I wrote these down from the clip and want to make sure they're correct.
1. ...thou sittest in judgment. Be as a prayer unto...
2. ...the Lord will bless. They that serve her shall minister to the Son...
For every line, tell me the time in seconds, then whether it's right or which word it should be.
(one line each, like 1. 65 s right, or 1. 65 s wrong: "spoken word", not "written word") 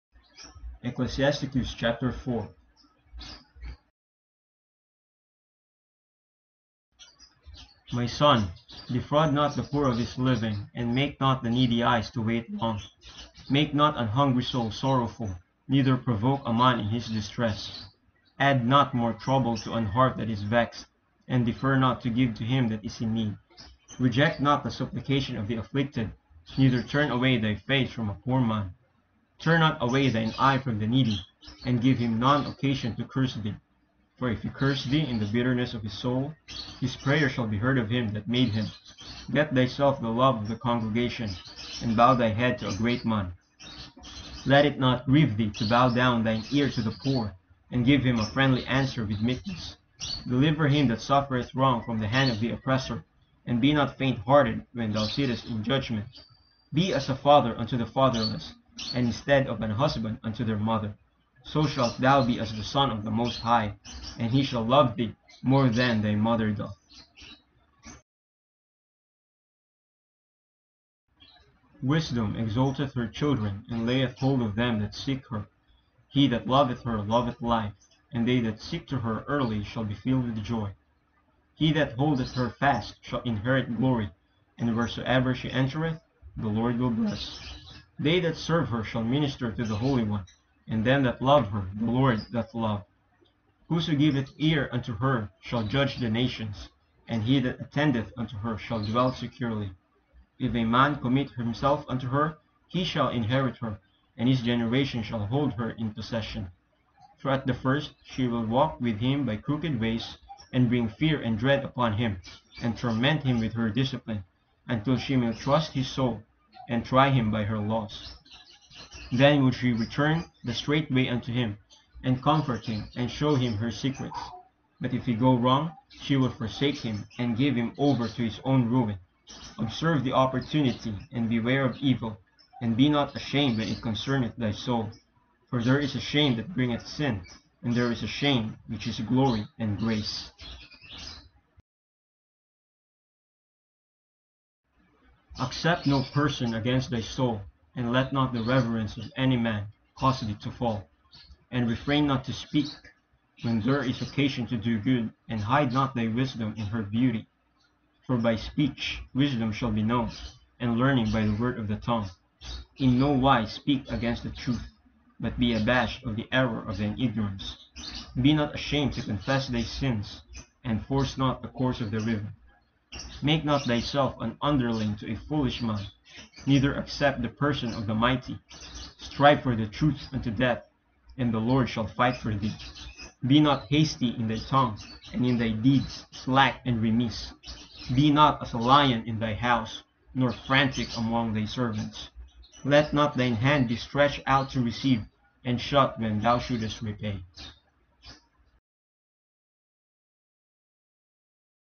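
1. 54 s wrong: "father", not "prayer"
2. 86 s wrong: "Holy", not "Son".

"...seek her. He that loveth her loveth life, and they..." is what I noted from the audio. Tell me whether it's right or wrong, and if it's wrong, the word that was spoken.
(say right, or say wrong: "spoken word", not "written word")
right.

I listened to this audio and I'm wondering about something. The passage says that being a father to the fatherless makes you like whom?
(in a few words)
The Son of the Most High.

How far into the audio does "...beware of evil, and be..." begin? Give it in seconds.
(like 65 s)
131 s.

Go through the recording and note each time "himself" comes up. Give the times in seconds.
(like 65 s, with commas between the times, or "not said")
101 s.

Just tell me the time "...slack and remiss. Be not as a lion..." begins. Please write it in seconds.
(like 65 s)
186 s.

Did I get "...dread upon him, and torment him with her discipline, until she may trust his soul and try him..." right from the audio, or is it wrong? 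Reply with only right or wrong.
right.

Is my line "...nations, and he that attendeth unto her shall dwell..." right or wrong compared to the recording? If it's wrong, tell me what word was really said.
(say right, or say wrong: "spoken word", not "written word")
right.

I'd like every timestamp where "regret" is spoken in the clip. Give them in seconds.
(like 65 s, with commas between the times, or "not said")
not said.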